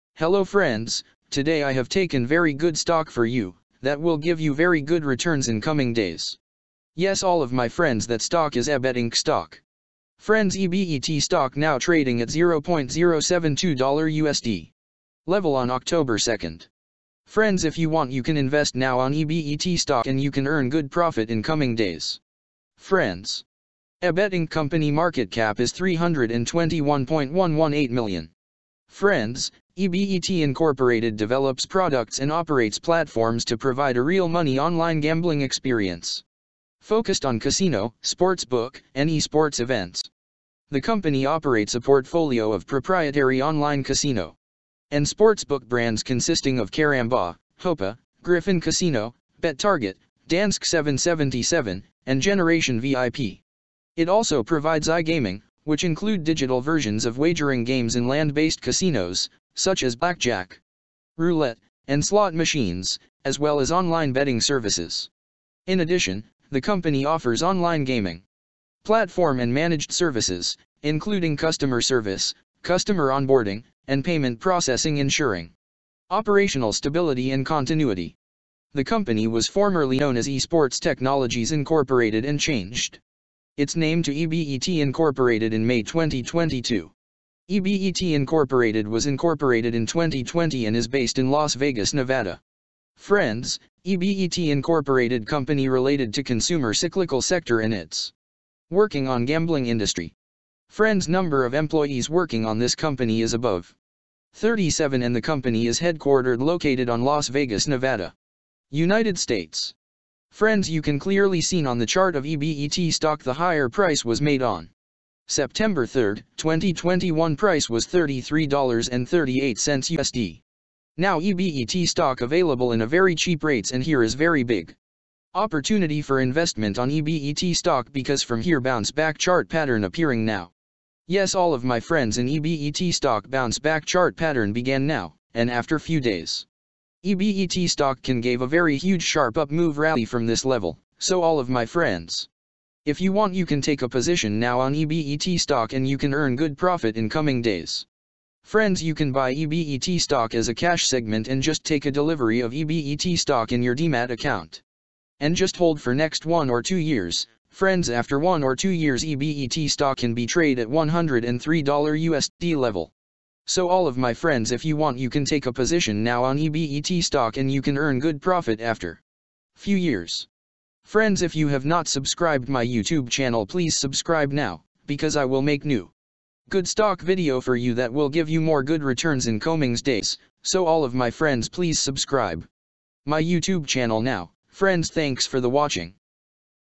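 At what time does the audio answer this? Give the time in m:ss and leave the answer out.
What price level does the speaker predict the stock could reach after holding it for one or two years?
2:40.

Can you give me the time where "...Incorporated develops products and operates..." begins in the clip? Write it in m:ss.
0:30.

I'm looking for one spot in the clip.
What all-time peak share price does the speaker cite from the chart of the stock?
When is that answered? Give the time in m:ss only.
1:57.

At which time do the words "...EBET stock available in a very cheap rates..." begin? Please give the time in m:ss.
2:01.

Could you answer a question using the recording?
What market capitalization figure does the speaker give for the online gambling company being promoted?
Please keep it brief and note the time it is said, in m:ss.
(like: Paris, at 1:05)
321.118 million, at 0:25.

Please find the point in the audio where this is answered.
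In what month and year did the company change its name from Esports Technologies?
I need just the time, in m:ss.
1:25.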